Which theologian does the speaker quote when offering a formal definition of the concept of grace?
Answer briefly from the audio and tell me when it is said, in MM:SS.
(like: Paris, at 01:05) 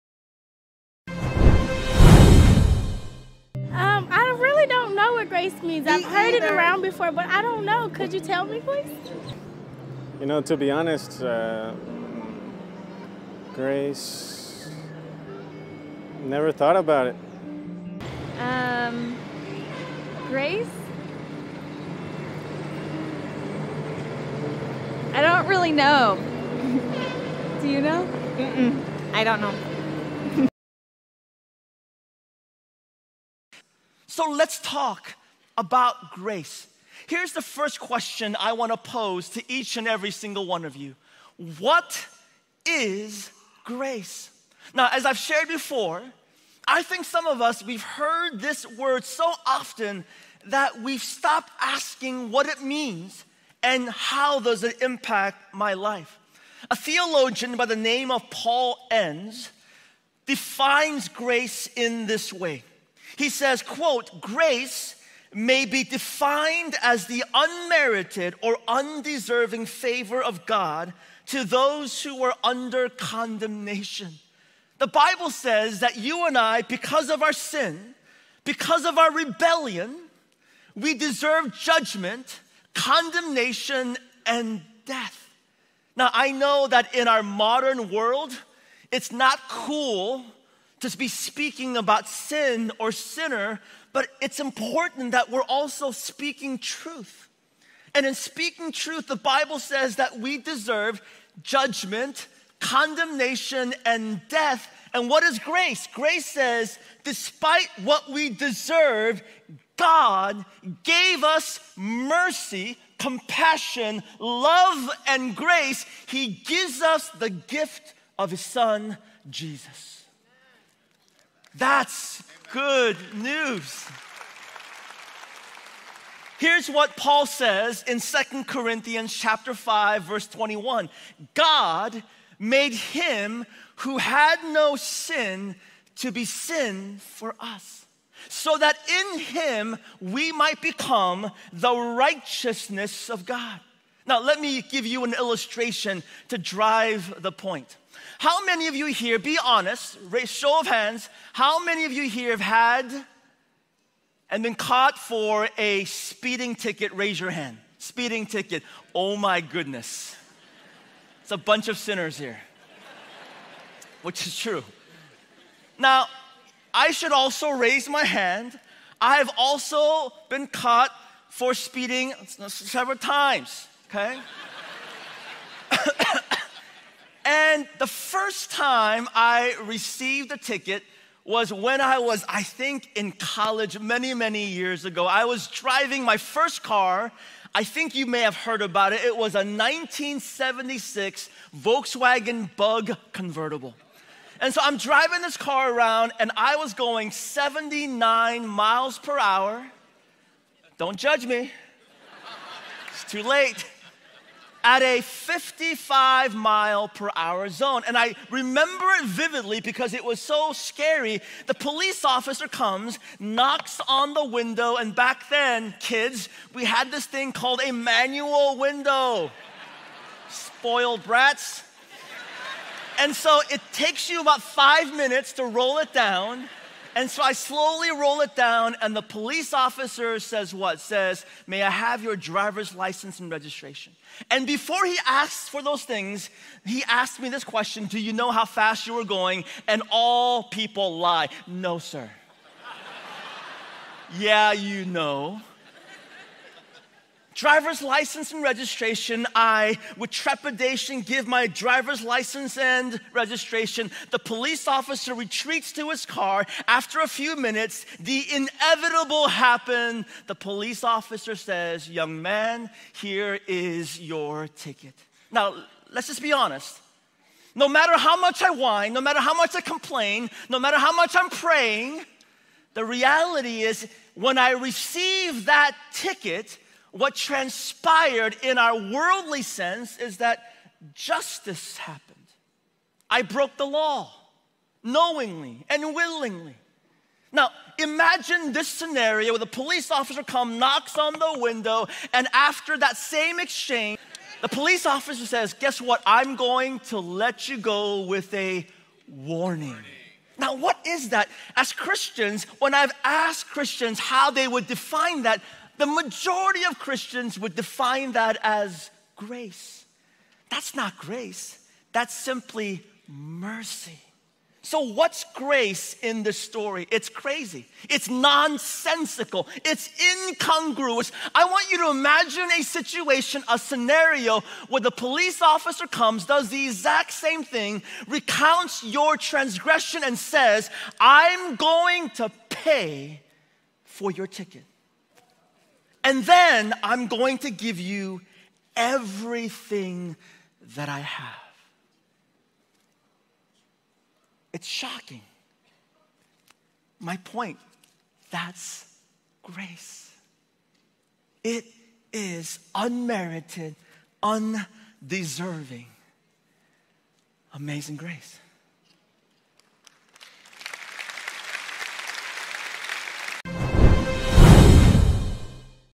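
Paul Enns, at 00:58.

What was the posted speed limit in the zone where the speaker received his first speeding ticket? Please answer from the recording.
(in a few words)
55 mph.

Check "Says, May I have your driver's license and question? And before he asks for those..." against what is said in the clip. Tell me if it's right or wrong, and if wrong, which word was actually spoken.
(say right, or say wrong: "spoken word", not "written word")
wrong: "registration", not "question".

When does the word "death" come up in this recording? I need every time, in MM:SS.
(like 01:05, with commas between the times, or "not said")
01:24, 01:44.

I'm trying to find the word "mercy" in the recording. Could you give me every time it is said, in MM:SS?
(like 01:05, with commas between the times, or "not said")
01:51, 05:13.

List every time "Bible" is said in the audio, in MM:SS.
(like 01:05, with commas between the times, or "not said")
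01:14, 01:39.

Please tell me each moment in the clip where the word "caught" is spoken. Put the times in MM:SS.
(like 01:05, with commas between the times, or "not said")
02:34, 02:50.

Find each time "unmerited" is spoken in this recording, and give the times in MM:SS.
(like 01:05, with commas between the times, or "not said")
01:07, 05:52.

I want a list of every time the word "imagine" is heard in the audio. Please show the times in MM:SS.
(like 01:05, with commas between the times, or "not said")
04:47, 05:21.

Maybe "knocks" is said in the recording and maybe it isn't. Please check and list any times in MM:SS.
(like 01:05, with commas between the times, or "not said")
03:33, 04:50.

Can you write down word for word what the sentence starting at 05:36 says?
And then I'm going to give you everything that I have.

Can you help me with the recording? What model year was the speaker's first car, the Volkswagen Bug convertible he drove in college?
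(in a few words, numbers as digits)
1976.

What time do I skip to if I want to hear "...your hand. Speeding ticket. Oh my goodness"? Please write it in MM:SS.
02:37.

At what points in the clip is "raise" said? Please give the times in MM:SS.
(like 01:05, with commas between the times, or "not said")
02:30, 02:36, 02:47.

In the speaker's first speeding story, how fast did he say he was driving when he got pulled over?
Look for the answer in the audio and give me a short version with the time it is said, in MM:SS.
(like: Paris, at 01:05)
79 mph, at 03:17.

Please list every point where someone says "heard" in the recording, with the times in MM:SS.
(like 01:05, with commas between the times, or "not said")
00:06, 00:47, 03:08.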